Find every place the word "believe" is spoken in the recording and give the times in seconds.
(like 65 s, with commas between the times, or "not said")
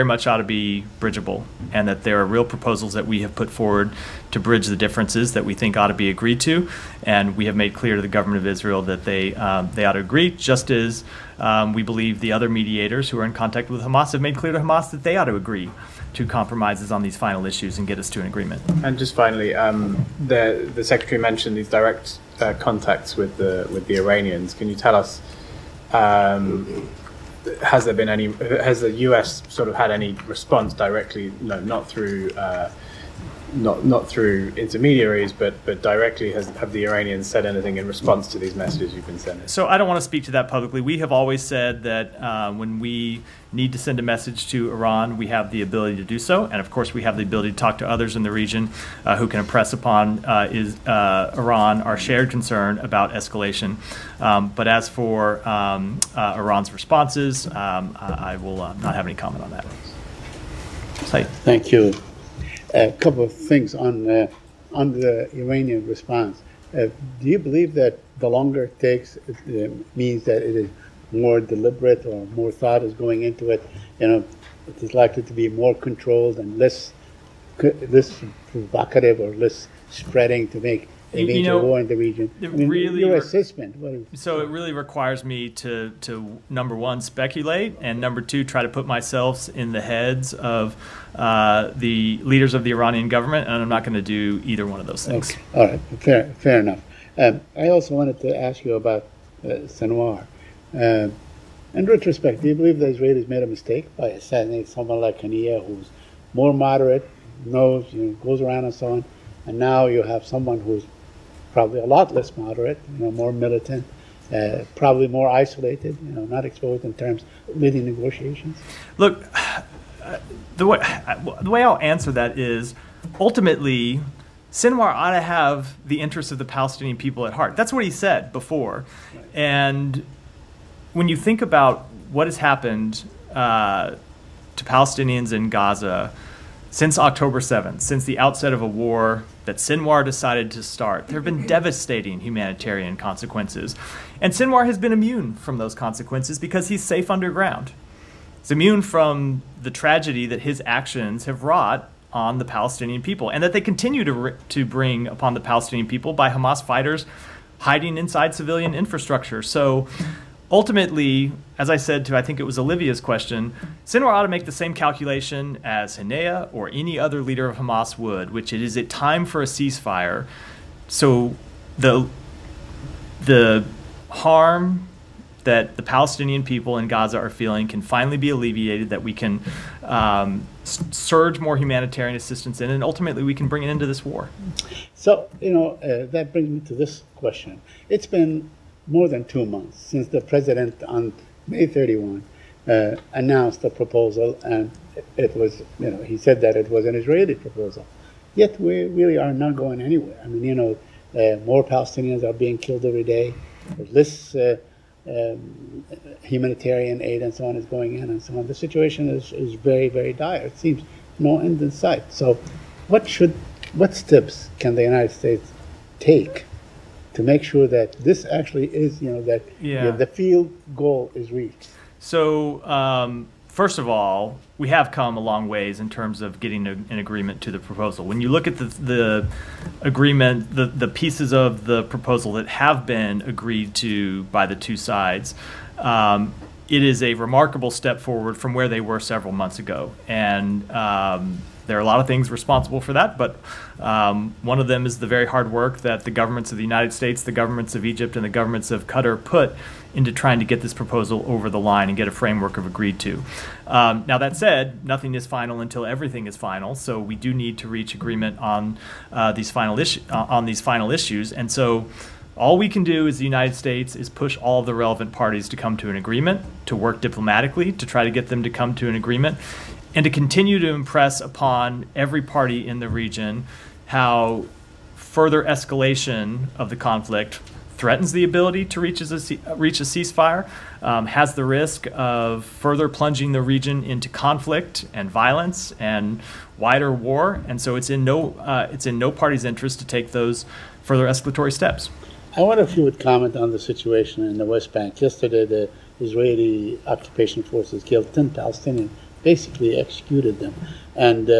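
11 s, 67 s, 102 s.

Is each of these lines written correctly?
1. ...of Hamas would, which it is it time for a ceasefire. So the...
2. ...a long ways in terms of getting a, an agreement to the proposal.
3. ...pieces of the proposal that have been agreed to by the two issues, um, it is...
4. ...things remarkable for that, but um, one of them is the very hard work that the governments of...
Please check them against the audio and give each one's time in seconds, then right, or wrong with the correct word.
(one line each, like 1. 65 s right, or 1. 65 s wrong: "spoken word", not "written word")
1. 167 s right
2. 225 s right
3. 230 s wrong: "sides", not "issues"
4. 242 s wrong: "responsible", not "remarkable".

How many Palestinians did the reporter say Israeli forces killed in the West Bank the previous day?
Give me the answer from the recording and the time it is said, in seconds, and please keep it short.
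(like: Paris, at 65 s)
10, at 298 s.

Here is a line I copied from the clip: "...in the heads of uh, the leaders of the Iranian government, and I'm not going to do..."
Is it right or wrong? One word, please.
right.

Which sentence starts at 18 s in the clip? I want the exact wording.
And just finally, um, the the secretary mentioned these direct uh, contacts with the with the Iranians.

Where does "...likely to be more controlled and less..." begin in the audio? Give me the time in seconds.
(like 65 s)
74 s.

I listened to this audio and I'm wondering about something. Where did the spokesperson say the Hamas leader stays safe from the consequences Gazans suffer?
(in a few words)
Underground.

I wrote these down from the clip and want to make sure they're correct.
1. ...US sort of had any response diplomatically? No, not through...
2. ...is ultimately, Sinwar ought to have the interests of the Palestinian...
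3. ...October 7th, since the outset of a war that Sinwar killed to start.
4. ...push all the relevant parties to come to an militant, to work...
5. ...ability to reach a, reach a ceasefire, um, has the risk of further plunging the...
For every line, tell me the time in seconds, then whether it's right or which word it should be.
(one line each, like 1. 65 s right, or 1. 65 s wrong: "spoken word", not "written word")
1. 29 s wrong: "directly", not "diplomatically"
2. 122 s right
3. 136 s wrong: "decided", not "killed"
4. 264 s wrong: "agreement", not "militant"
5. 278 s right.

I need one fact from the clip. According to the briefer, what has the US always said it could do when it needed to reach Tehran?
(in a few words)
Send a message.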